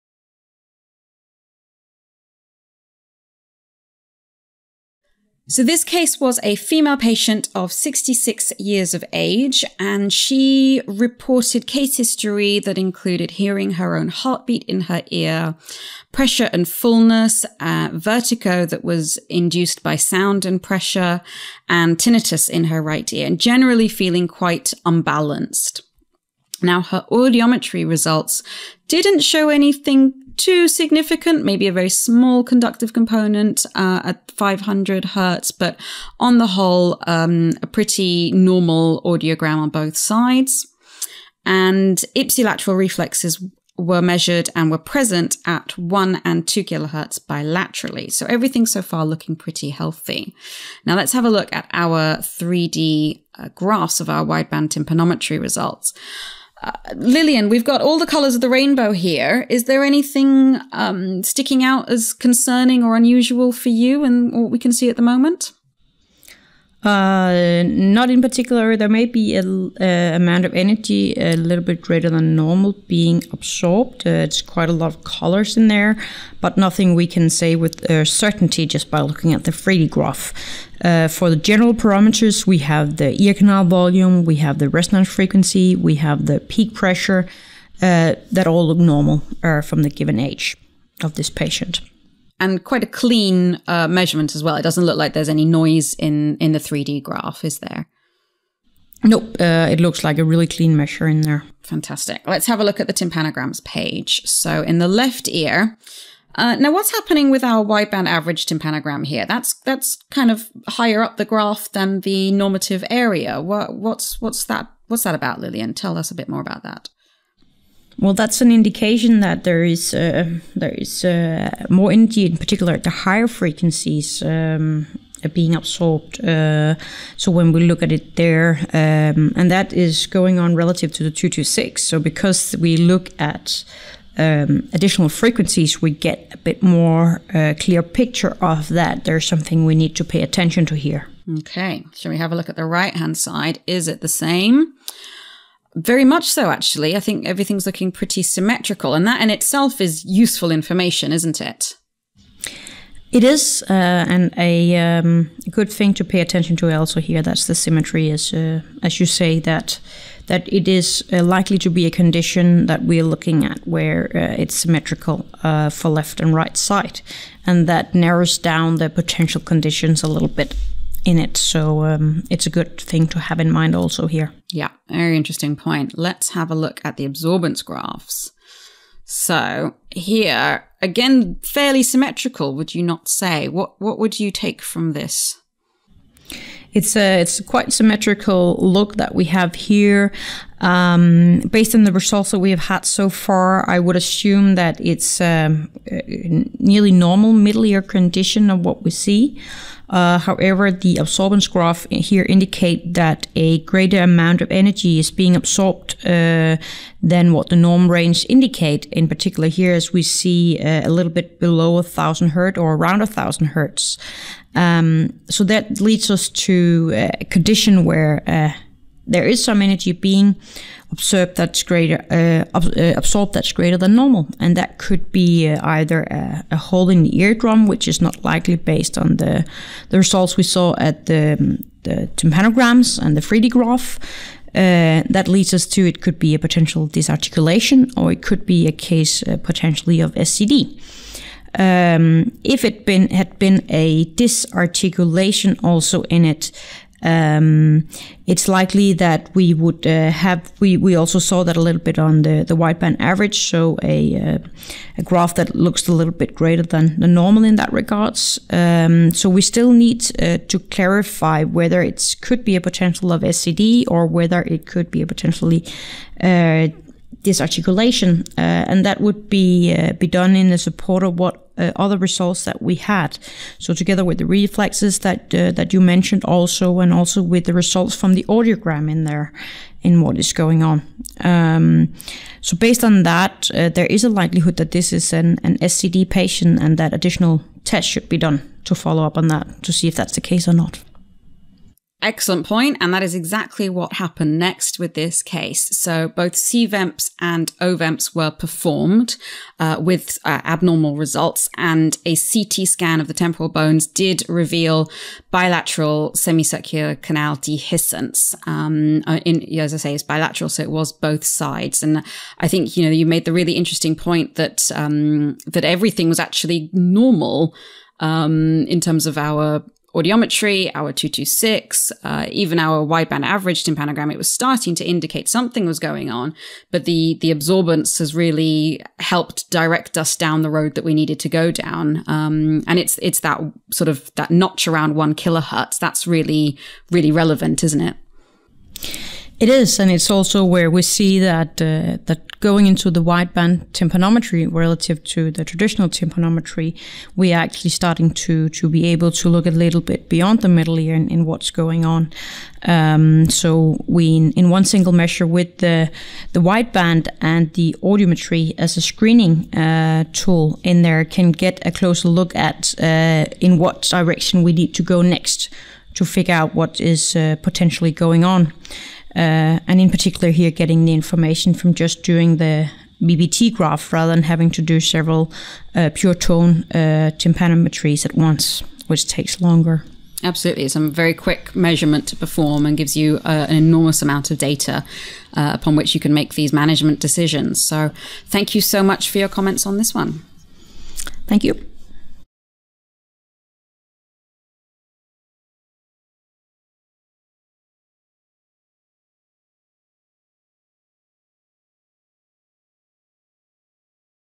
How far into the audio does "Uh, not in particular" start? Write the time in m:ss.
1:06.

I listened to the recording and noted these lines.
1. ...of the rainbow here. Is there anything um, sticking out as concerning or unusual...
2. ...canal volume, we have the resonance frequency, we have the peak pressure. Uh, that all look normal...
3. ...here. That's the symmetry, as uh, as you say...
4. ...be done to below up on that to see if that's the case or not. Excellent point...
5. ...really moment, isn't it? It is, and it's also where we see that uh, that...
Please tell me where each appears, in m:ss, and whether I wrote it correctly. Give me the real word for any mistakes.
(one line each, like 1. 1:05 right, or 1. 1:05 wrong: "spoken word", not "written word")
1. 0:58 right
2. 1:23 right
3. 2:36 right
4. 4:48 wrong: "follow", not "below"
5. 5:36 wrong: "relevant", not "moment".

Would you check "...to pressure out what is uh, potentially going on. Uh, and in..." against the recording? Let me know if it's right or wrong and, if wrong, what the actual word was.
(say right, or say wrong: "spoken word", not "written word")
wrong: "figure", not "pressure".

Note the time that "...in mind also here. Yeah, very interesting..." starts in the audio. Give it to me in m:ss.
2:53.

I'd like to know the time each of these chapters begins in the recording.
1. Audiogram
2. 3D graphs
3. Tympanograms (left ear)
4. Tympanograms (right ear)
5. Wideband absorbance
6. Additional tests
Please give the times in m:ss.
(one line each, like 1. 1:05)
1. 0:26
2. 0:52
3. 1:42
4. 2:22
5. 2:56
6. 4:52.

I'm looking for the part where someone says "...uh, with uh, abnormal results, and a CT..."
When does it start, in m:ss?
4:59.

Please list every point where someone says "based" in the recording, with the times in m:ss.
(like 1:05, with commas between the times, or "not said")
3:11, 3:48, 4:42.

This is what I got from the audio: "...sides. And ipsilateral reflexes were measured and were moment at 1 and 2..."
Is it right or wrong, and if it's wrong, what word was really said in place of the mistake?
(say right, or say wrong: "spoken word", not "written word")
wrong: "present", not "moment".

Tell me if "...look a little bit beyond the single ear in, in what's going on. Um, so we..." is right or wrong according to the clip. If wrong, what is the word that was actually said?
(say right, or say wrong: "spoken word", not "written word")
wrong: "middle", not "single".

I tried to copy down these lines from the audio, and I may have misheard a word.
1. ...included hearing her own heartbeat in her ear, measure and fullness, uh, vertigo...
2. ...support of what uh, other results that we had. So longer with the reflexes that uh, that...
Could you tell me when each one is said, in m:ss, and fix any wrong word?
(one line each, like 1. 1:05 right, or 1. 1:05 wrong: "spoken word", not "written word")
1. 0:12 wrong: "pressure", not "measure"
2. 4:30 wrong: "together", not "longer".